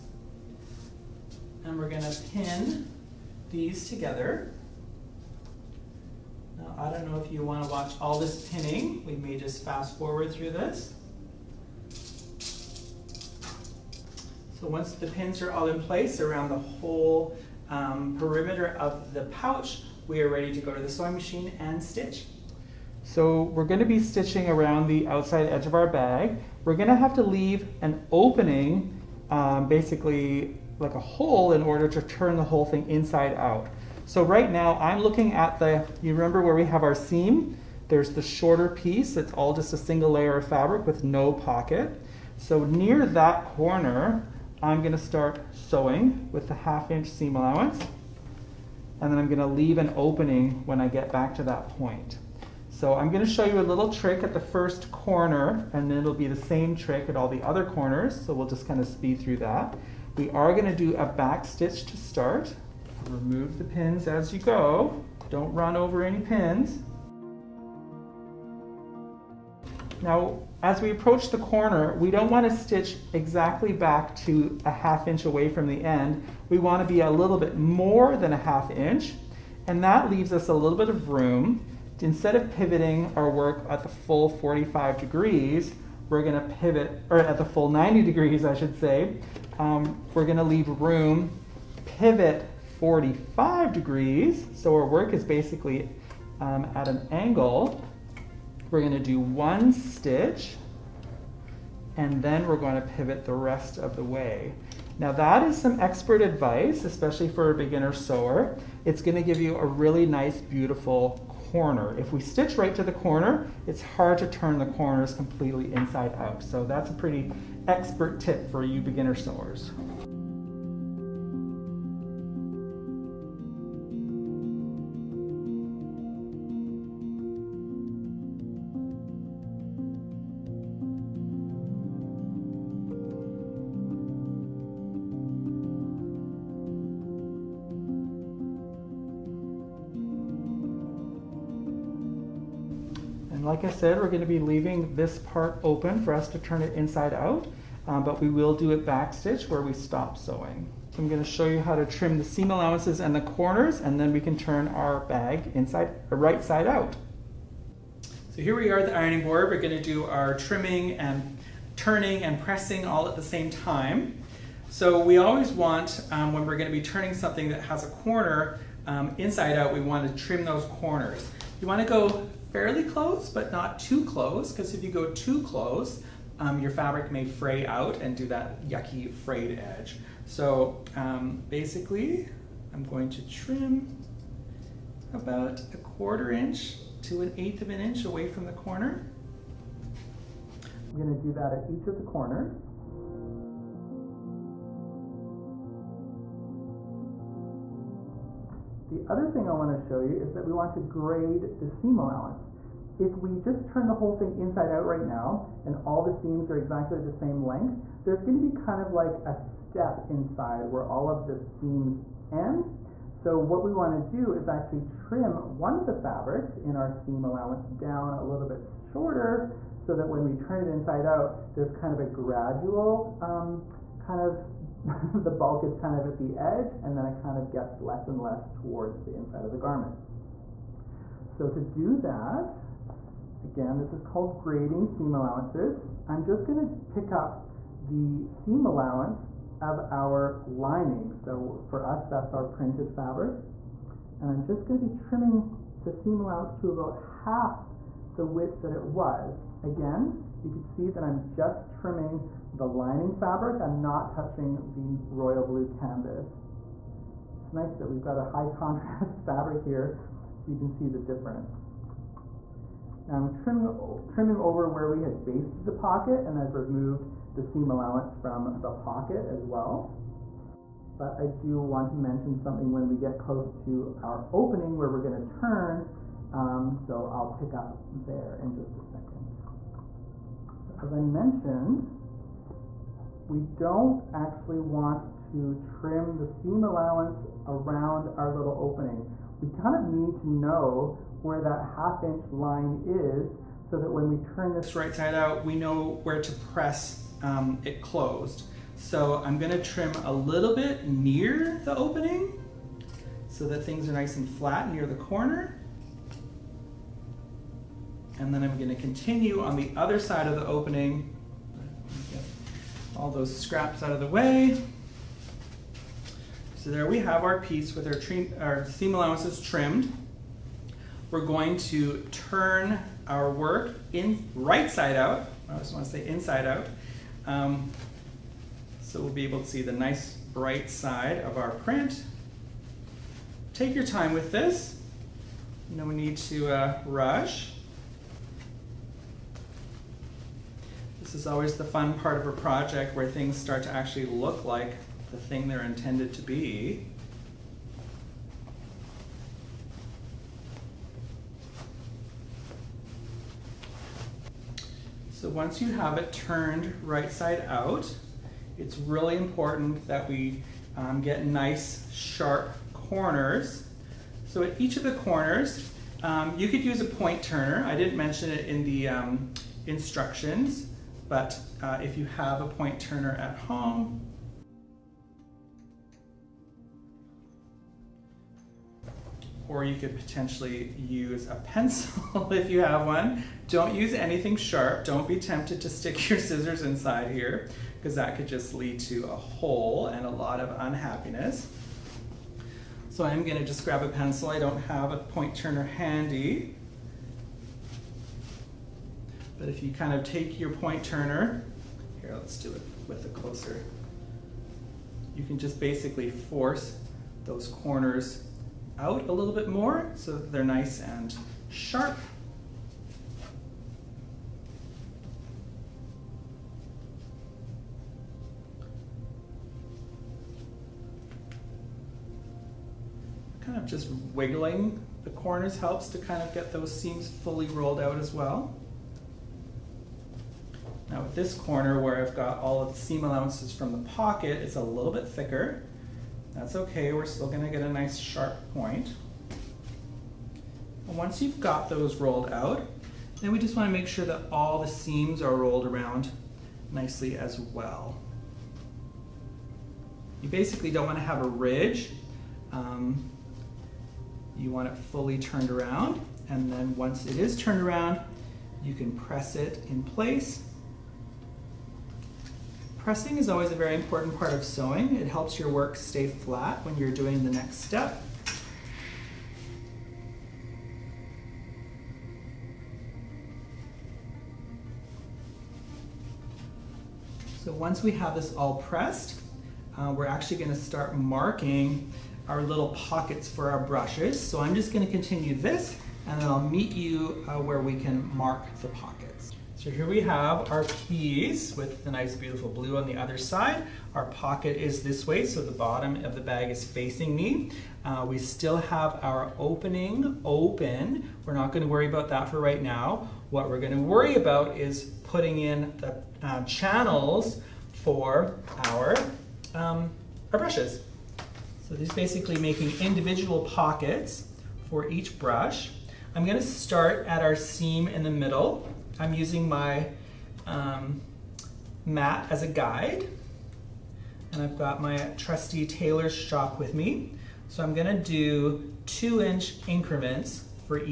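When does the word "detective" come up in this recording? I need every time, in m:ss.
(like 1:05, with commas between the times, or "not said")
not said.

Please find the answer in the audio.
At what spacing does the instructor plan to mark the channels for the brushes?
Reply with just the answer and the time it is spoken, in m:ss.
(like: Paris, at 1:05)
2 inch increments, at 8:48.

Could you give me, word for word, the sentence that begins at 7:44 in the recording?
It helps your work stay flat when you're doing the next step.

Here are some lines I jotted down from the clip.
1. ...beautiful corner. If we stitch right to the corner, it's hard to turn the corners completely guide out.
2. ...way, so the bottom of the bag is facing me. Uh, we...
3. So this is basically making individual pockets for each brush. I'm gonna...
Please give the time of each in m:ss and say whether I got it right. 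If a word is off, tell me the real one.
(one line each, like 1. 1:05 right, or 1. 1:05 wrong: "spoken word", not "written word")
1. 1:50 wrong: "inside", not "guide"
2. 8:15 right
3. 8:31 right.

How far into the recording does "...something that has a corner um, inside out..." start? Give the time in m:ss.
2:47.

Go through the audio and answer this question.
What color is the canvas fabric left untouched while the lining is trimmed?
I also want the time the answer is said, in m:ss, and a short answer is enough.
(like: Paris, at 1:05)
royal blue, at 4:15.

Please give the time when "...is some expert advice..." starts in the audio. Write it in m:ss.
1:45.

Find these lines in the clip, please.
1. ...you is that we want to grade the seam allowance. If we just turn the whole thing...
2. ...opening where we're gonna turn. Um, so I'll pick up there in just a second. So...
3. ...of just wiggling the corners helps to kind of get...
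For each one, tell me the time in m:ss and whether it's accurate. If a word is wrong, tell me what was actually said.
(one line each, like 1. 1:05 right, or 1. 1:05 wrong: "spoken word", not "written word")
1. 3:19 right
2. 4:34 right
3. 7:03 right.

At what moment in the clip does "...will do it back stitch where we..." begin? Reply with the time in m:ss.
2:28.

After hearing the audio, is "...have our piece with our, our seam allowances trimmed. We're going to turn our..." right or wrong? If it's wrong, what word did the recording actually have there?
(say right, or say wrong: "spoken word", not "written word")
right.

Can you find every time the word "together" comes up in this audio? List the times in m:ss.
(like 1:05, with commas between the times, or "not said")
0:03.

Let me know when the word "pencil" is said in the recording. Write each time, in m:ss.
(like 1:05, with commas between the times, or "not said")
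6:21, 6:33.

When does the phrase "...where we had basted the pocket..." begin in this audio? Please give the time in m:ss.
4:24.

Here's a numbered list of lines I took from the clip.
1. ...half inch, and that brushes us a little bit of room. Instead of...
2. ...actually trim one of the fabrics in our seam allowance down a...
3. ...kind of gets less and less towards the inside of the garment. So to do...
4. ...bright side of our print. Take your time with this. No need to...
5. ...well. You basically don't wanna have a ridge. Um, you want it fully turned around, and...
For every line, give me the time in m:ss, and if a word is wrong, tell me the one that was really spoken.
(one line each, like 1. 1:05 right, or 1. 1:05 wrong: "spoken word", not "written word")
1. 1:18 wrong: "leaves", not "brushes"
2. 3:34 right
3. 3:47 right
4. 5:30 right
5. 7:27 right.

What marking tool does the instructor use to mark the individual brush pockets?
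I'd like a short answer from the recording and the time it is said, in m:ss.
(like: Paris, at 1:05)
tailor's chalk, at 8:45.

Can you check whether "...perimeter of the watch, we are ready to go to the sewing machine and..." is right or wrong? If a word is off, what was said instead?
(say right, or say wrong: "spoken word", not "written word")
wrong: "pouch", not "watch".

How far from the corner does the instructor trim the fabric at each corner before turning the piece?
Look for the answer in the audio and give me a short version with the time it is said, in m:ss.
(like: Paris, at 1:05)
a quarter inch to an eighth of an inch, at 3:05.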